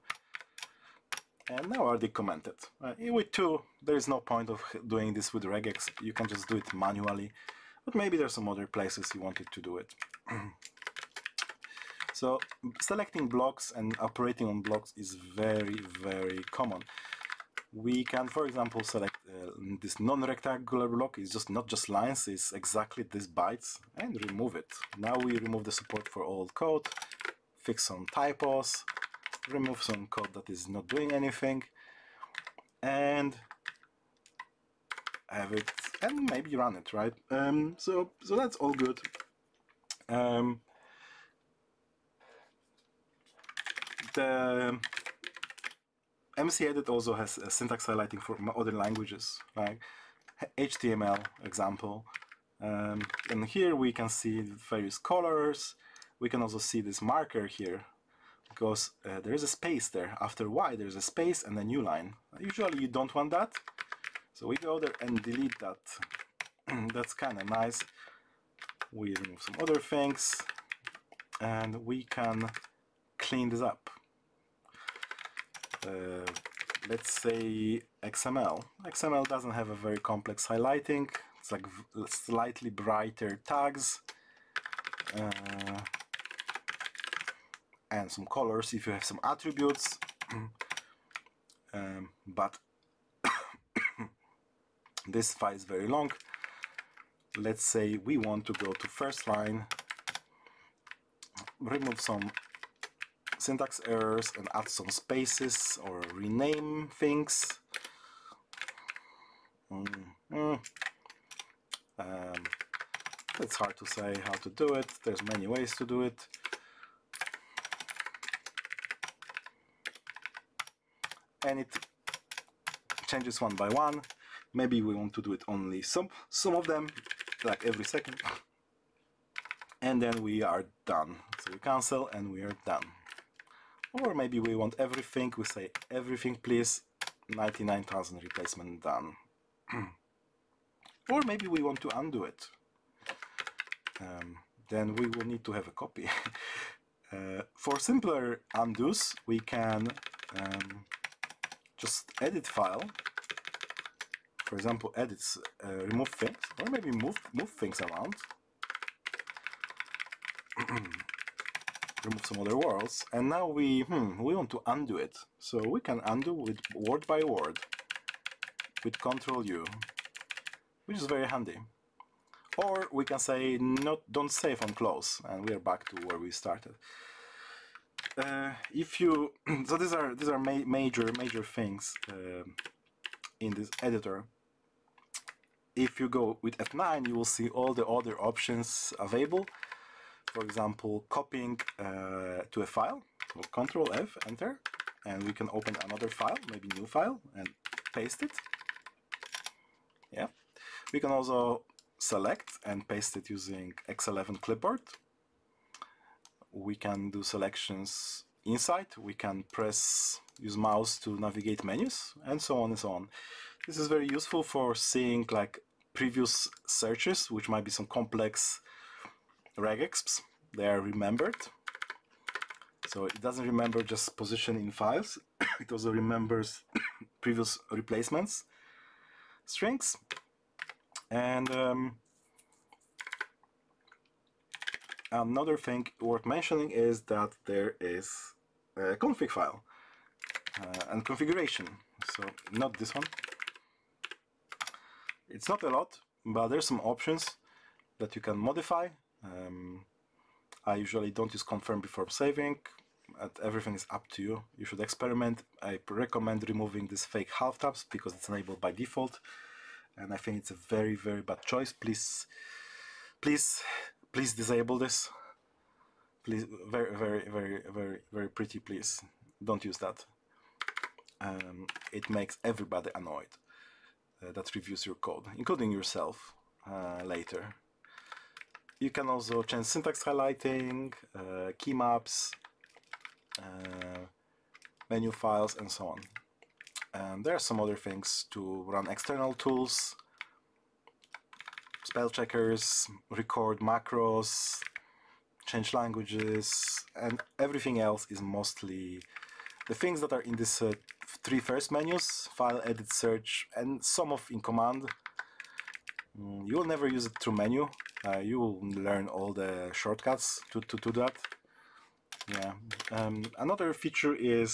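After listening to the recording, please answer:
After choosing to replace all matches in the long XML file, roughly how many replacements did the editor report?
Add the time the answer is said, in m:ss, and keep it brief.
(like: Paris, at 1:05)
99,000, at 2:17.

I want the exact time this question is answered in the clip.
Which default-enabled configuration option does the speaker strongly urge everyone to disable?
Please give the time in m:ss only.
4:17.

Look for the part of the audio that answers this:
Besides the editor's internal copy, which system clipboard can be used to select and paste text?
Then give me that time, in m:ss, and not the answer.
3:23.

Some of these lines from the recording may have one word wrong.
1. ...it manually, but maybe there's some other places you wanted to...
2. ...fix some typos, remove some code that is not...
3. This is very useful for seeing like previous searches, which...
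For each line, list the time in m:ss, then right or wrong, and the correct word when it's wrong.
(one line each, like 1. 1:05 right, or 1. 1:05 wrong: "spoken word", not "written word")
1. 0:06 right
2. 0:27 right
3. 3:33 right.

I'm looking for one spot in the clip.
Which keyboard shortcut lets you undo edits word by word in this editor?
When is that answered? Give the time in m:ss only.
2:49.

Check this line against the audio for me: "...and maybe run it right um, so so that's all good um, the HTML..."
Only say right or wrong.
wrong.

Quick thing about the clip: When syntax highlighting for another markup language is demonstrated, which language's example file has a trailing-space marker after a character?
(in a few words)
HTML.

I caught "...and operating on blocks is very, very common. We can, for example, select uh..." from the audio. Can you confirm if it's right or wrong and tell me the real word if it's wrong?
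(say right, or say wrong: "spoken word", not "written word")
right.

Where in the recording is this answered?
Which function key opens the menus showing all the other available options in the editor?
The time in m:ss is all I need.
3:06.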